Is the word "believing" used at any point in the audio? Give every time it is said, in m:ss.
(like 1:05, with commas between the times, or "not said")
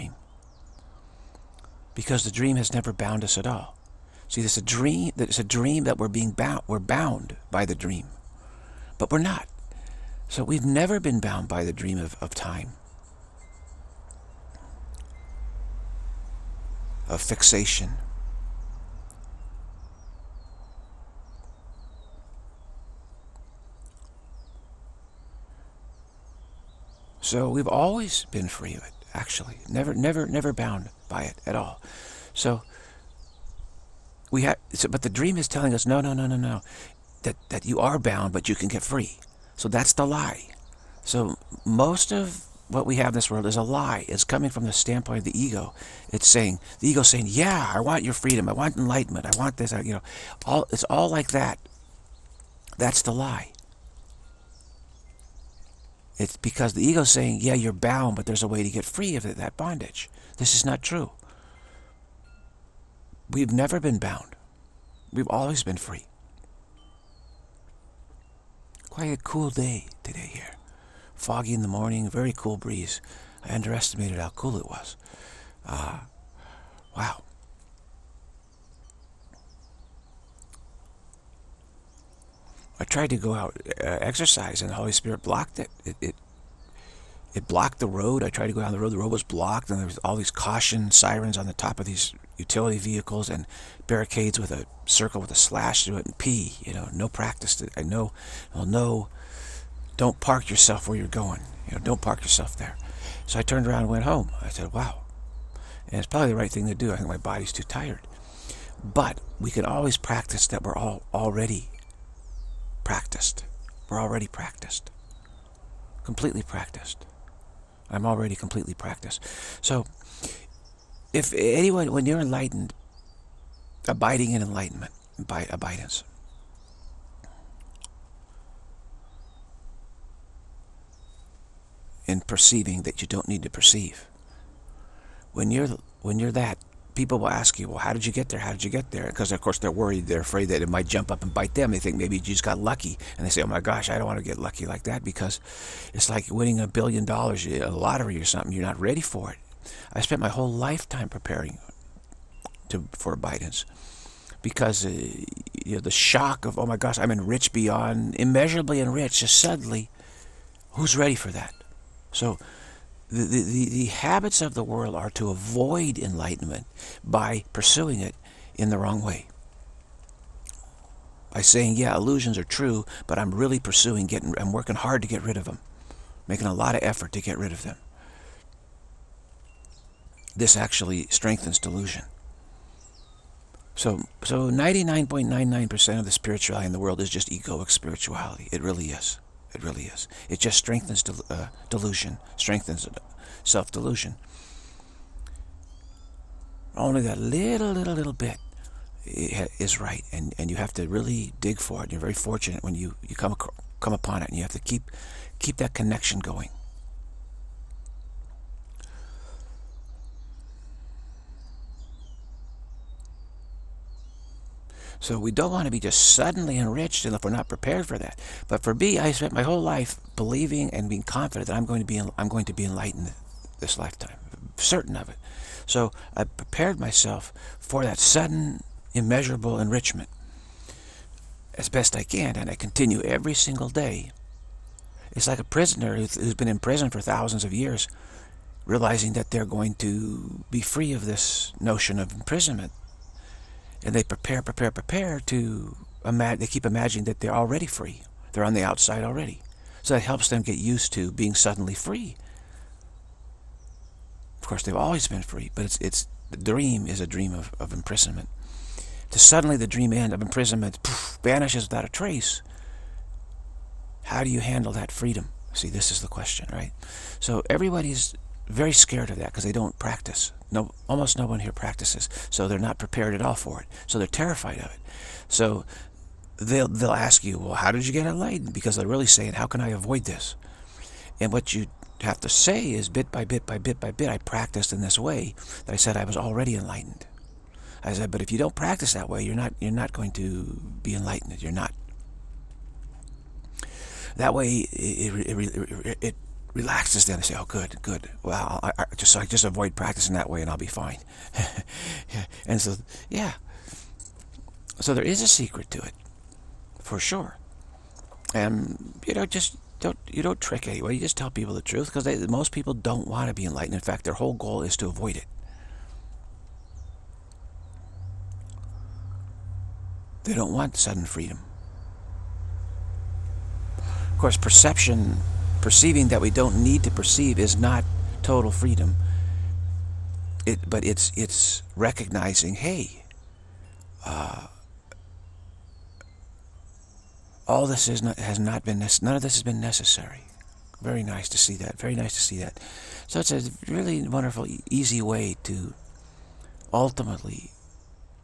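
3:40.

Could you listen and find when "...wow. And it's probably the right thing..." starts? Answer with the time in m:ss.
1:44.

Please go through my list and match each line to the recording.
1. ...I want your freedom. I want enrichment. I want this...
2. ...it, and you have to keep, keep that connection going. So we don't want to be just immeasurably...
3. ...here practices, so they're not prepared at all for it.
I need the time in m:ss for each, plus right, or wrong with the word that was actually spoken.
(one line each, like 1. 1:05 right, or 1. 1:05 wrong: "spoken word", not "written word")
1. 0:47 wrong: "enlightenment", not "enrichment"
2. 3:24 wrong: "suddenly", not "immeasurably"
3. 4:31 right.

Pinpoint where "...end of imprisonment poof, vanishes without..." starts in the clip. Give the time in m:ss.
4:19.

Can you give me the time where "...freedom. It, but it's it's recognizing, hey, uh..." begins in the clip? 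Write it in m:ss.
5:28.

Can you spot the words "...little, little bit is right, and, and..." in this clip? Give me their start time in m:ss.
3:17.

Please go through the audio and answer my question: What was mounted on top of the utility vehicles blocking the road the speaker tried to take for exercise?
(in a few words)
caution sirens.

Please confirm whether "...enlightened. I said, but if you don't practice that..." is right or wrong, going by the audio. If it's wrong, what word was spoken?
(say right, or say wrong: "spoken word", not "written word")
right.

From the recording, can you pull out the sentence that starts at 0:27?
So we've always been free of it, actually.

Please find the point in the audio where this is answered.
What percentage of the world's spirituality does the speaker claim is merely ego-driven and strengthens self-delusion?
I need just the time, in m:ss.
3:04.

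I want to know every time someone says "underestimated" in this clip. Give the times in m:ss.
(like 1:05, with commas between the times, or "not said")
1:13.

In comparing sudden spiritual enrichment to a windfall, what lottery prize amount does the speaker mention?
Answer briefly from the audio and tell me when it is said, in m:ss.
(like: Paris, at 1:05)
a billion dollars, at 2:26.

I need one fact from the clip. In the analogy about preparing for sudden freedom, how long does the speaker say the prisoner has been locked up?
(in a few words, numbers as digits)
thousands of years.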